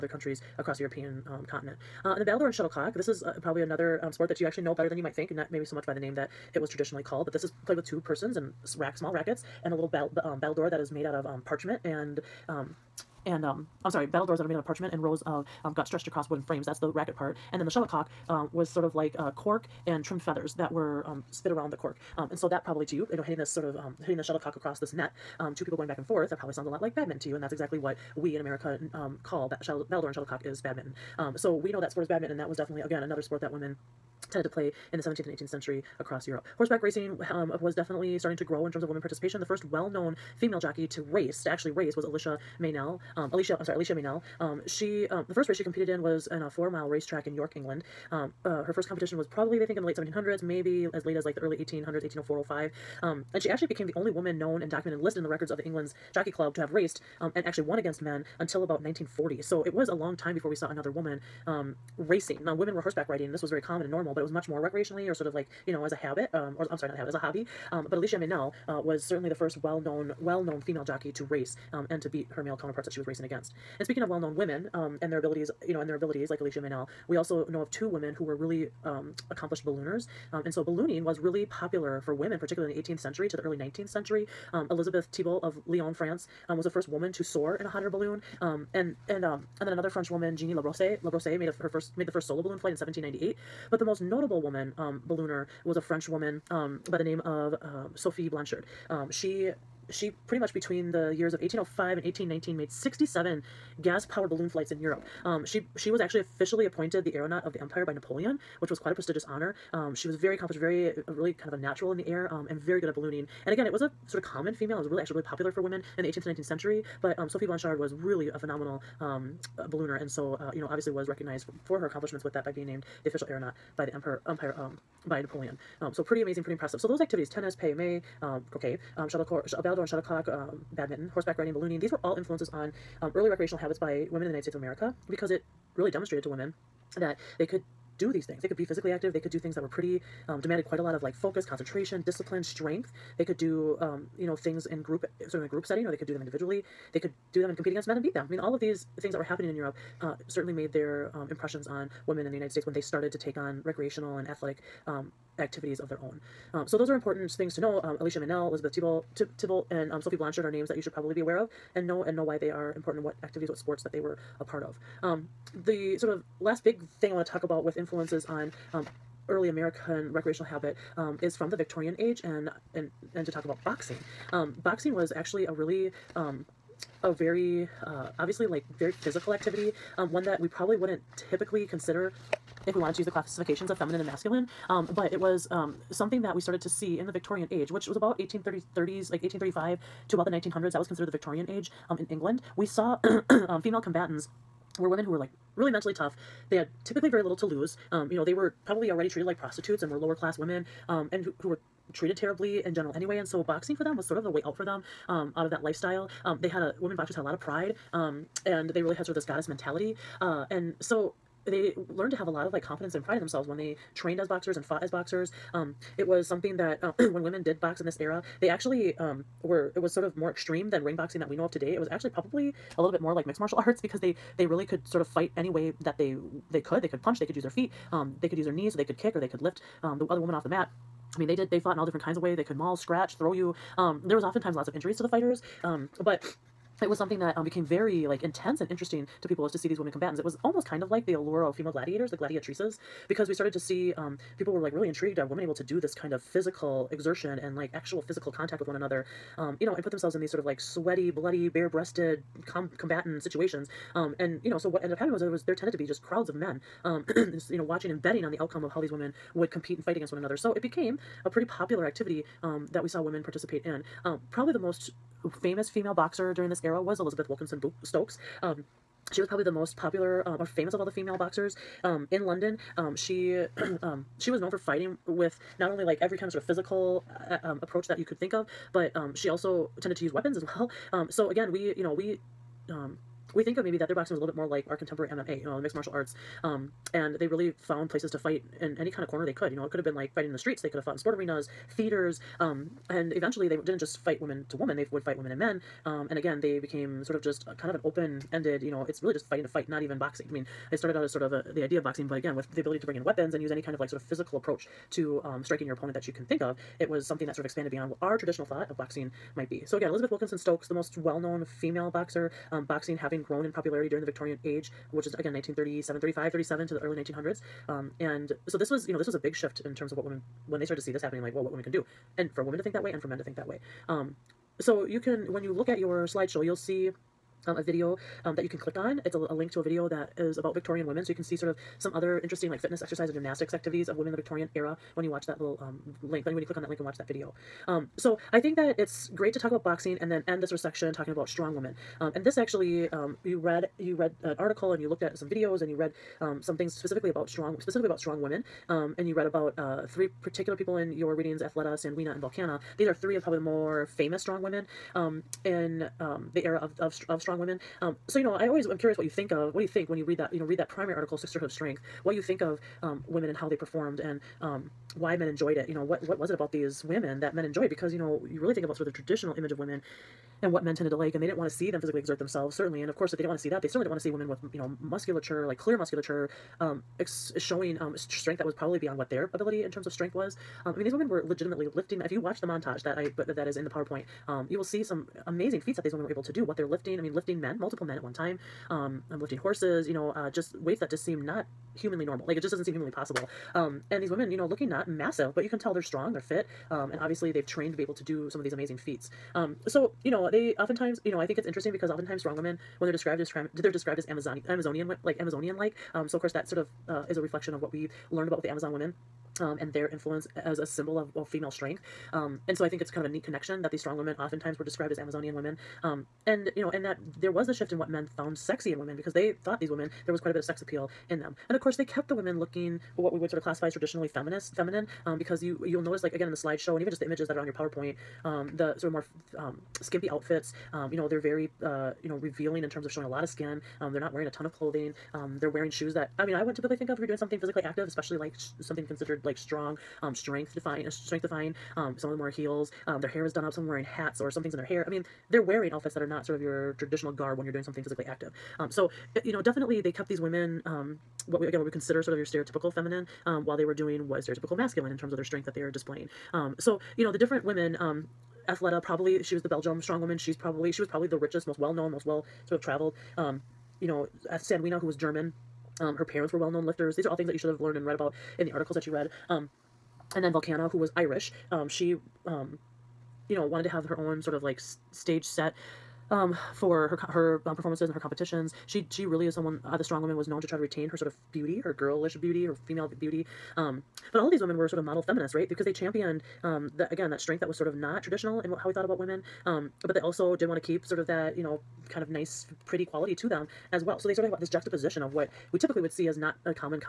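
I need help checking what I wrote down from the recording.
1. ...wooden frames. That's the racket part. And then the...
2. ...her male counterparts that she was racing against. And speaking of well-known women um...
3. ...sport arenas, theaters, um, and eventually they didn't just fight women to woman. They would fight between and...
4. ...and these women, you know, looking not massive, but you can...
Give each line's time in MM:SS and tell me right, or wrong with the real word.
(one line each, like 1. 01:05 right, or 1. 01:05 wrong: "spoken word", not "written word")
1. 00:16 right
2. 01:12 right
3. 04:50 wrong: "women", not "between"
4. 06:33 right.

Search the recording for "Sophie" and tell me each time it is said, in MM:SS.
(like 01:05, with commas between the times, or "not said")
01:37, 01:57, 02:40.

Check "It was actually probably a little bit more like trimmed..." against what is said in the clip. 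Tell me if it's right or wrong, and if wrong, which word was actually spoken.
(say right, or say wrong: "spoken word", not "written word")
wrong: "mixed", not "trimmed".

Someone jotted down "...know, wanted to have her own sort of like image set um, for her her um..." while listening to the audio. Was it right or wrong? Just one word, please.
wrong.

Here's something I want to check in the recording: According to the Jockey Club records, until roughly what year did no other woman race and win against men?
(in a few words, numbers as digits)
1940.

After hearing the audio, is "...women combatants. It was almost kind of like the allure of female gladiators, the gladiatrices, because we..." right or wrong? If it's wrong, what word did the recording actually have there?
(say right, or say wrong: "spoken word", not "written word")
right.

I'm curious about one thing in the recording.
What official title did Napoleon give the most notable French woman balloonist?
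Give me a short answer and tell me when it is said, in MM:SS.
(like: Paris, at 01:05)
aeronaut of the empire, at 01:47.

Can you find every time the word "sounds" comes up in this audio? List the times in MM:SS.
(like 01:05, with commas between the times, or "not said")
00:26.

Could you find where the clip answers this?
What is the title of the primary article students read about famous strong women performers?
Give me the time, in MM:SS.
06:01.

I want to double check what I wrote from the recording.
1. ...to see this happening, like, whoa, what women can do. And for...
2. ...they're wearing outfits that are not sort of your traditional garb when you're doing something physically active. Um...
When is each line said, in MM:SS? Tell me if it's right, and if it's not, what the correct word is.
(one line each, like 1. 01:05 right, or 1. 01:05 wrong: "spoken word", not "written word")
1. 05:20 right
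2. 07:25 right.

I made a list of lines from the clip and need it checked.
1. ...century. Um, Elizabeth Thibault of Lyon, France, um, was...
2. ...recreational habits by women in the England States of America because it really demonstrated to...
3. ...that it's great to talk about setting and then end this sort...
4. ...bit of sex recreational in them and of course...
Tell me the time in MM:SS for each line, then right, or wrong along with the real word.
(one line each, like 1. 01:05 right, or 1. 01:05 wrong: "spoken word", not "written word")
1. 01:23 right
2. 02:13 wrong: "United", not "England"
3. 05:38 wrong: "boxing", not "setting"
4. 07:00 wrong: "appeal", not "recreational".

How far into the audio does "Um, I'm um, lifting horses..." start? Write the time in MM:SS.
06:28.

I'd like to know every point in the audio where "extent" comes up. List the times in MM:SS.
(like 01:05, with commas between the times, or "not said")
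not said.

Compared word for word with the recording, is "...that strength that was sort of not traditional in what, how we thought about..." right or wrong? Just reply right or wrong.
right.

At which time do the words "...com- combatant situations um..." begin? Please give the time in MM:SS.
04:12.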